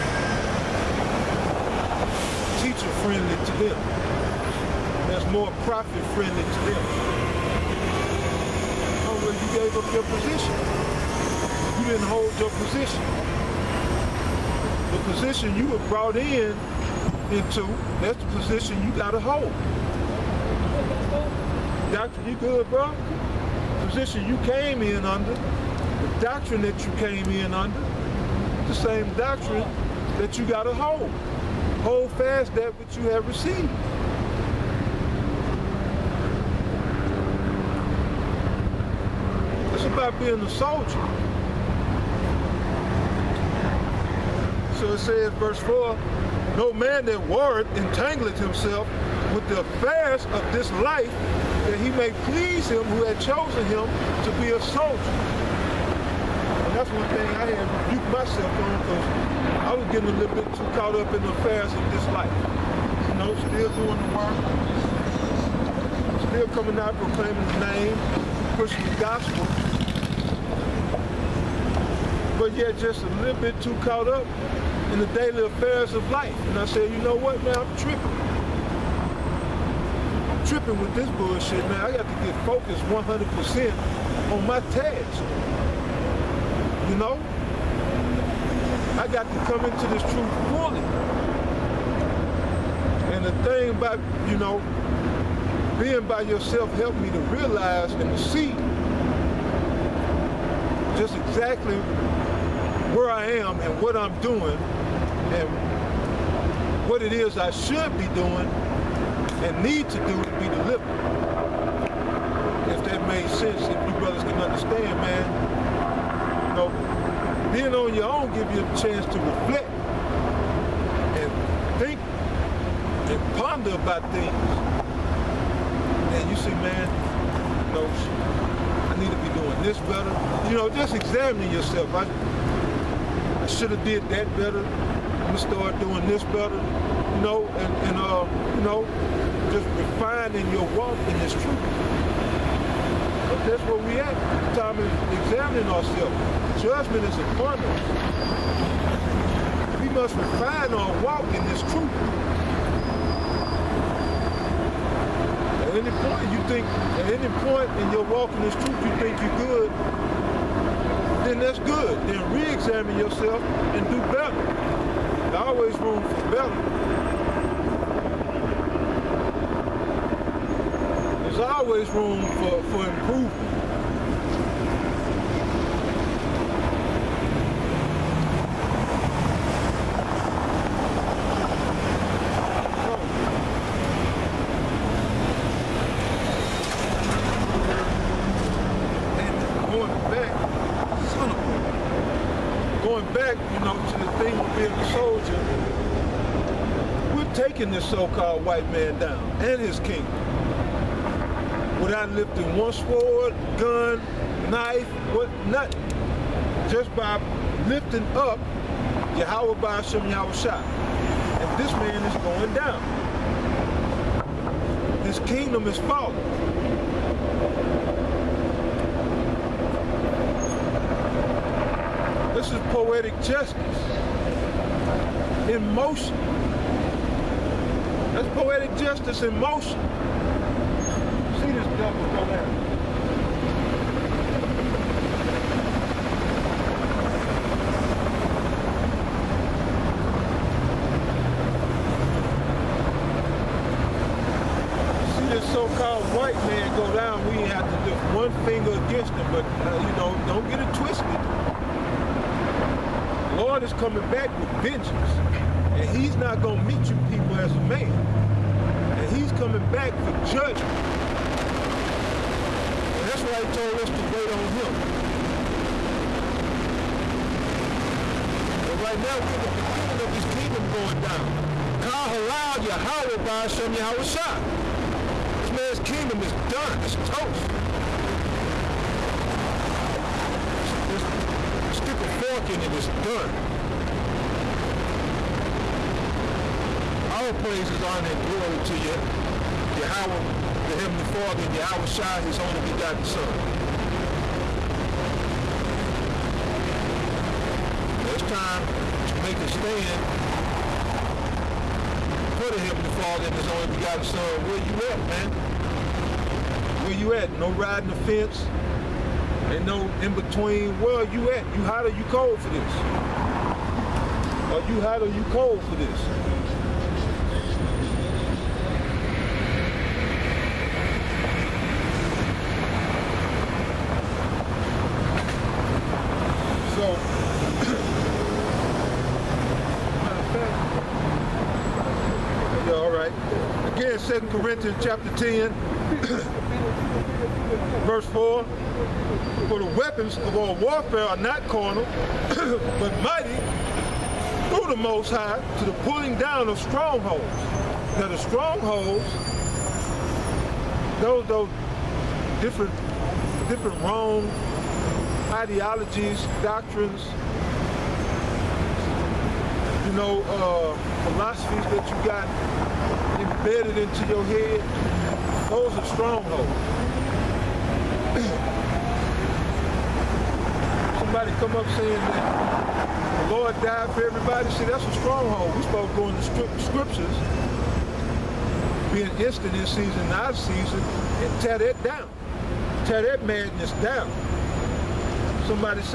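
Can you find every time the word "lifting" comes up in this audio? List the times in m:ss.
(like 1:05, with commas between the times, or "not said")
3:22, 3:27.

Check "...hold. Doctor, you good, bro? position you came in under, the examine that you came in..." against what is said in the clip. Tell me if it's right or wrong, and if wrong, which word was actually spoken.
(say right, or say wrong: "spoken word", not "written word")
wrong: "doctrine", not "examine".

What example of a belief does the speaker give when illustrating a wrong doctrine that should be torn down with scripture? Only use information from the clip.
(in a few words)
The Lord died for everybody.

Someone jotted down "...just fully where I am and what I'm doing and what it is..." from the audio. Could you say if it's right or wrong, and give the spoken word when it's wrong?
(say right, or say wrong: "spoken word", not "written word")
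wrong: "exactly", not "fully".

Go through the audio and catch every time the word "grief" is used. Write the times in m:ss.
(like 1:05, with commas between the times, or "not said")
not said.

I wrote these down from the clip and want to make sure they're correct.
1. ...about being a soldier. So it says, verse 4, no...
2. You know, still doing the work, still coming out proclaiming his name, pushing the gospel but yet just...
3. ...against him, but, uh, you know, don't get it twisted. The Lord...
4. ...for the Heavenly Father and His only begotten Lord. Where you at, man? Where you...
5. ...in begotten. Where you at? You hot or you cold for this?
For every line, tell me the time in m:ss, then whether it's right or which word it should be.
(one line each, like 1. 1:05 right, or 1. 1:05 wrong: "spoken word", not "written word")
1. 0:39 right
2. 1:03 right
3. 4:08 right
4. 5:02 wrong: "Son", not "Lord"
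5. 5:10 wrong: "between", not "begotten".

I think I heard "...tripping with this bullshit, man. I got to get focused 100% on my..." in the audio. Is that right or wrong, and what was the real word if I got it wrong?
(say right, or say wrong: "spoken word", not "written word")
right.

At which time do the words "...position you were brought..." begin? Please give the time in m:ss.
0:15.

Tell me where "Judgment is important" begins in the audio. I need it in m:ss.
2:26.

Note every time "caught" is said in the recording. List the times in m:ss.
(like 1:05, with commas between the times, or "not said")
1:00, 1:13.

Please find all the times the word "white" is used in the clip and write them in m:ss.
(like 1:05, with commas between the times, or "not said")
3:18, 4:06.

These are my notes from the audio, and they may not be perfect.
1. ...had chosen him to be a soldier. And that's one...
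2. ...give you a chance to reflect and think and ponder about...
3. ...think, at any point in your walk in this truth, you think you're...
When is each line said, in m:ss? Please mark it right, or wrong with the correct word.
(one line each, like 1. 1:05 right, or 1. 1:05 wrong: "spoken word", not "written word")
1. 0:53 right
2. 1:58 right
3. 2:36 right.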